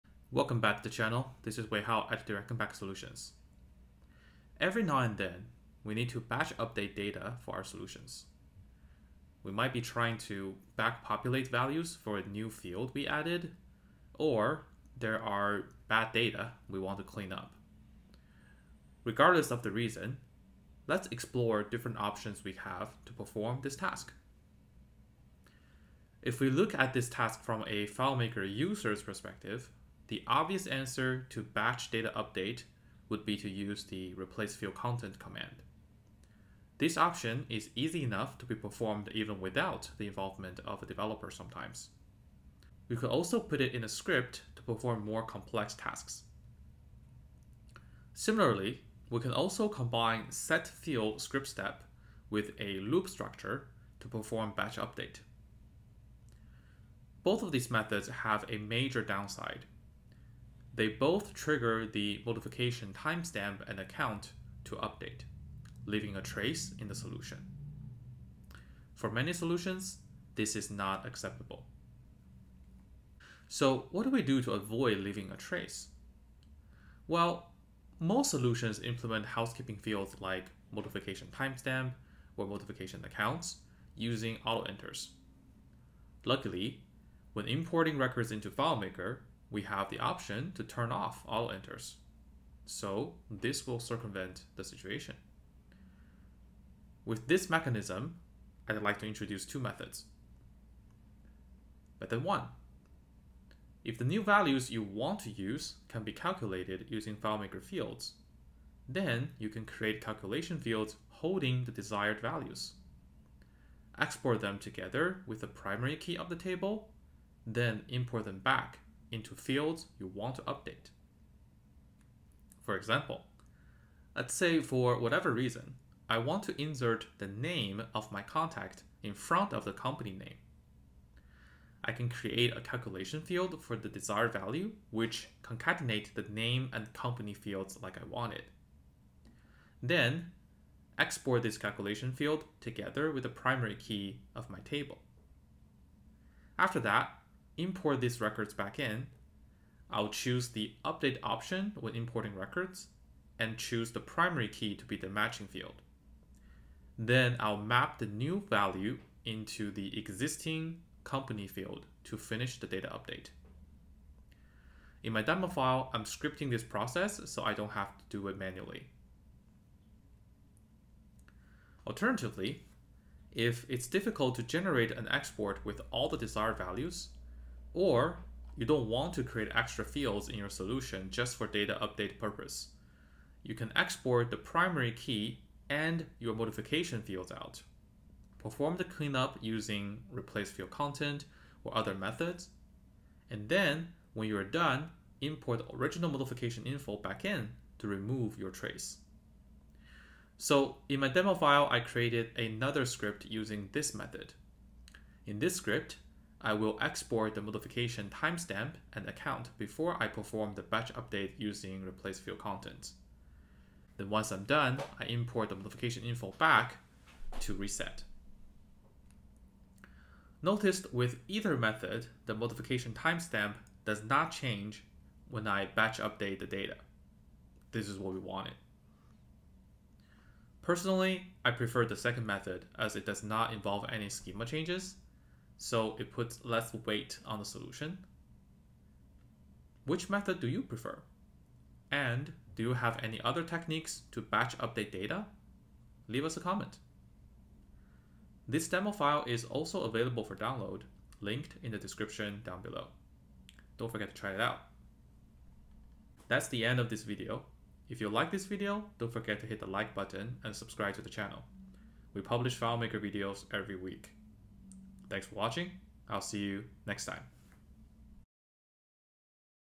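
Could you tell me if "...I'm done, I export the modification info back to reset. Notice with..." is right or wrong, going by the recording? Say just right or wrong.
wrong.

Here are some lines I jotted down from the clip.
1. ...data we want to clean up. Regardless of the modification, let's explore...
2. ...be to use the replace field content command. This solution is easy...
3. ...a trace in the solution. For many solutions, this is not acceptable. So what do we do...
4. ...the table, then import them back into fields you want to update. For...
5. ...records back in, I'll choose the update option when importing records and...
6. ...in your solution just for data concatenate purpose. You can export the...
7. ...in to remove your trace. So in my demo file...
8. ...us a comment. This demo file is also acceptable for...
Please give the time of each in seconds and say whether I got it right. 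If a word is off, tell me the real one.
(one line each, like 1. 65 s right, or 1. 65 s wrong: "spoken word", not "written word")
1. 16 s wrong: "reason", not "modification"
2. 33 s wrong: "option", not "solution"
3. 66 s right
4. 116 s right
5. 148 s right
6. 180 s wrong: "update", not "concatenate"
7. 197 s right
8. 246 s wrong: "available", not "acceptable".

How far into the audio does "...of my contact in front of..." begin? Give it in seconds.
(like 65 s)
127 s.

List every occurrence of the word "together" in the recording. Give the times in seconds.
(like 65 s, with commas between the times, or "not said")
114 s, 142 s.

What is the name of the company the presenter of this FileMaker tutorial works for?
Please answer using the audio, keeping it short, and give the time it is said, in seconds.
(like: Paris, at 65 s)
Direct Impact Solutions, at 2 s.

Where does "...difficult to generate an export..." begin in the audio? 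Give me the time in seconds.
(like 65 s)
173 s.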